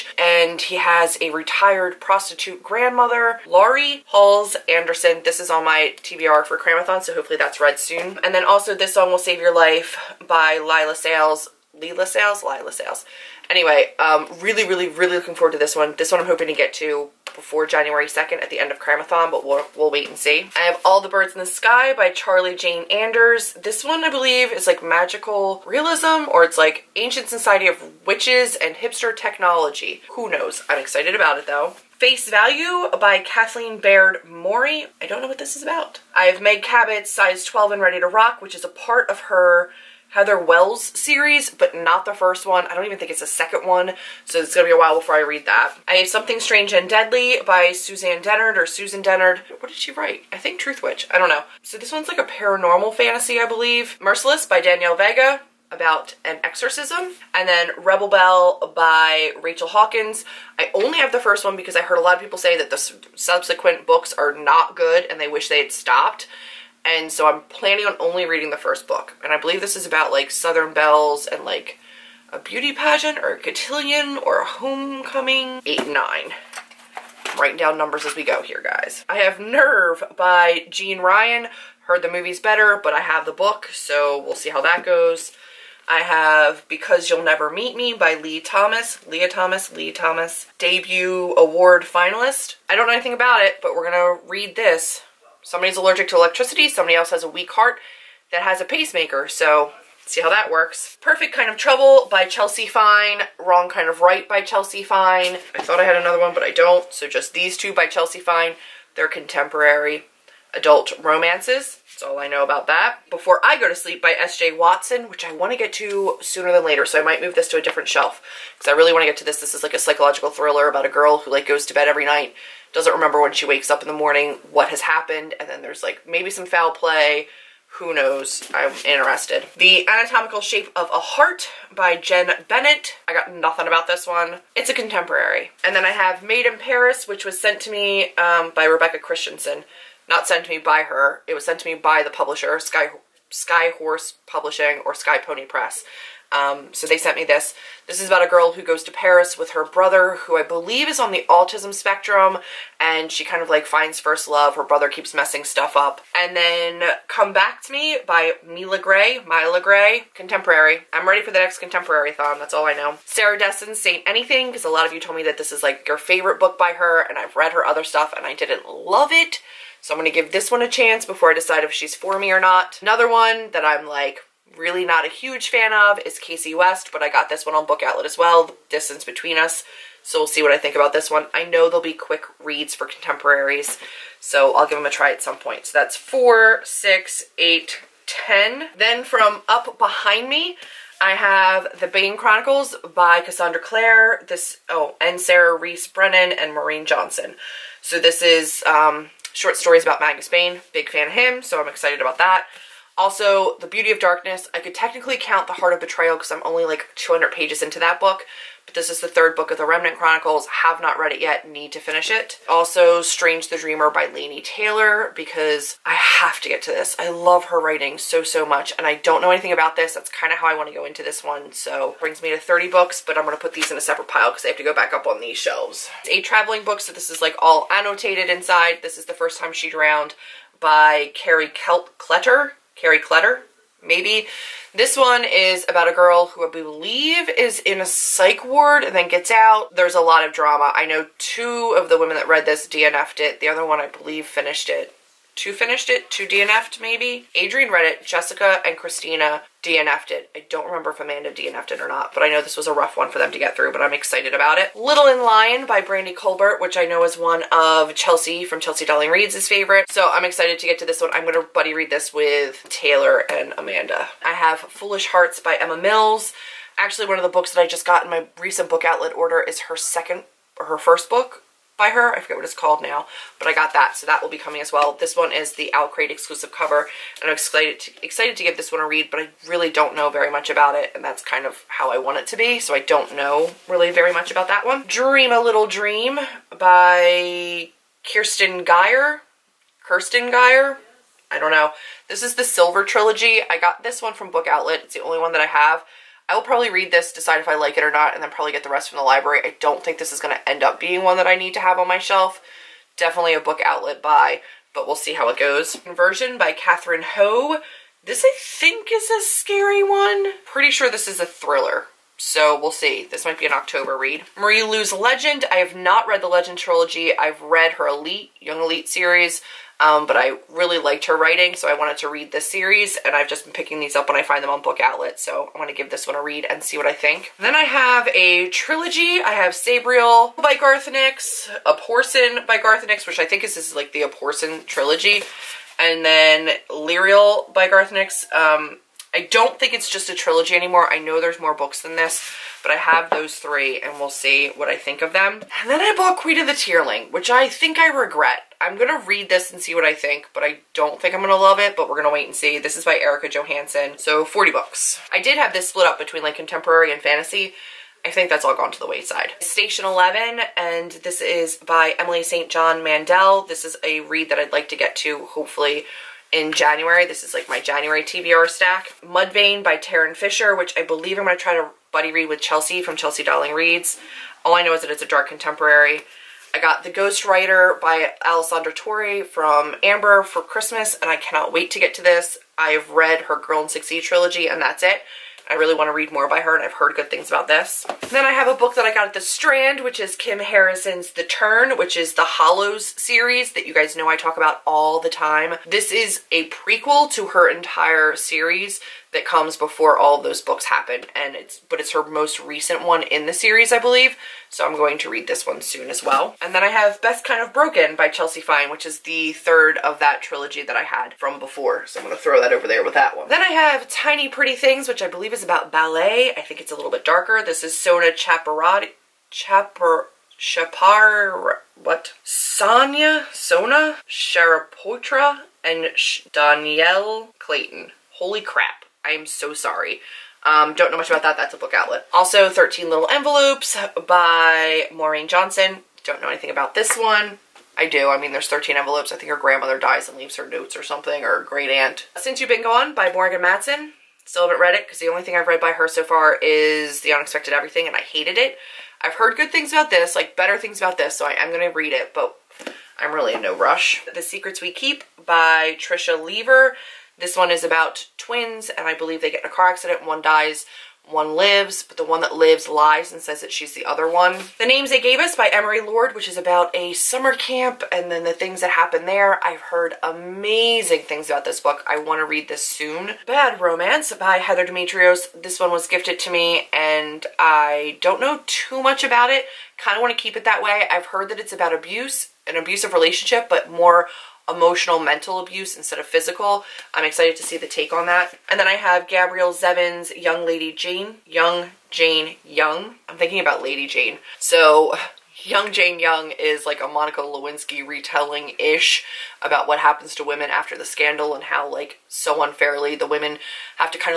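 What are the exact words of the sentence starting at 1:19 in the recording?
I have Nerve by Jeanne Ryan.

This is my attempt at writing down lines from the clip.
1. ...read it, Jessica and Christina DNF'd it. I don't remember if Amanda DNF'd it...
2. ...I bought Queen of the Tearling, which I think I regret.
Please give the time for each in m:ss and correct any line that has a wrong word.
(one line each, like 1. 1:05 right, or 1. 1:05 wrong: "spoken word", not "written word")
1. 4:07 right
2. 5:45 right.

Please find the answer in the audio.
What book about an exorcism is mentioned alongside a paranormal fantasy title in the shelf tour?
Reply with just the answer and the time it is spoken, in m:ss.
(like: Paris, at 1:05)
Merciless, at 0:53.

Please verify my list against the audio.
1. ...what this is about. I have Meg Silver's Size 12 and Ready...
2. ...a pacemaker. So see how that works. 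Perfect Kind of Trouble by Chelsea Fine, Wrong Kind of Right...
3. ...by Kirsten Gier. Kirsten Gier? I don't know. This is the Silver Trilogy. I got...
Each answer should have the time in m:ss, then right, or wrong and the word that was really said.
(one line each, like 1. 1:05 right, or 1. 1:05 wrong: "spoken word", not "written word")
1. 0:35 wrong: "Cabot", not "Silver"
2. 1:38 right
3. 4:46 right.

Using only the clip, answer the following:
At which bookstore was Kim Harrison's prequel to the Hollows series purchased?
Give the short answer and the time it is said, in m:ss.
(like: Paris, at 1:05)
the Strand, at 6:29.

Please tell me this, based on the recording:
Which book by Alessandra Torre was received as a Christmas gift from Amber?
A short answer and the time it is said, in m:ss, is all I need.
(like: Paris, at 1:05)
The Ghost Writer, at 6:16.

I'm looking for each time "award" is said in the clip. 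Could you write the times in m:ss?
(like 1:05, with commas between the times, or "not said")
1:31.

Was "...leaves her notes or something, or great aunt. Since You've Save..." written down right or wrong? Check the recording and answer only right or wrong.
wrong.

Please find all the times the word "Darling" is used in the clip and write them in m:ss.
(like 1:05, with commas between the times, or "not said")
4:18, 6:13.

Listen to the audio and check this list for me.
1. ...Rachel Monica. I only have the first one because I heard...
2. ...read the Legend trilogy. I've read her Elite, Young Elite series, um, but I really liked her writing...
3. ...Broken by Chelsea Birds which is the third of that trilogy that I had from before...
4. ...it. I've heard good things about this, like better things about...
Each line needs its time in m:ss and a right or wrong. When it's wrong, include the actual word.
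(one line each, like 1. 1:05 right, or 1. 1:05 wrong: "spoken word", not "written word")
1. 0:59 wrong: "Hawkins", not "Monica"
2. 5:16 right
3. 6:47 wrong: "Fine", not "Birds"
4. 7:28 right.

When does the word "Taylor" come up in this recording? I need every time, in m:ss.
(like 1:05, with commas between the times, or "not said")
3:34, 4:22.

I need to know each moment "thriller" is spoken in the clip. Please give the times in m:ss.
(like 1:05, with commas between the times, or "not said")
2:00, 5:11.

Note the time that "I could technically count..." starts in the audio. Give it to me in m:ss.
3:24.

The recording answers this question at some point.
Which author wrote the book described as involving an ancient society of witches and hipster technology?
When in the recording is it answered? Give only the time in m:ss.
0:22.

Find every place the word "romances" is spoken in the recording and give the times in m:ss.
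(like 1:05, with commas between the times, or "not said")
1:51, 7:53.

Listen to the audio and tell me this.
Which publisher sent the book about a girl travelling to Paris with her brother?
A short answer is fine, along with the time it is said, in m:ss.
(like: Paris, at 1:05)
Sky Pony Press, at 2:24.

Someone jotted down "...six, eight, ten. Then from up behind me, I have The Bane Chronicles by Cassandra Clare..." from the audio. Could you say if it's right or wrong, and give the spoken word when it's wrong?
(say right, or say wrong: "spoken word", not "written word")
right.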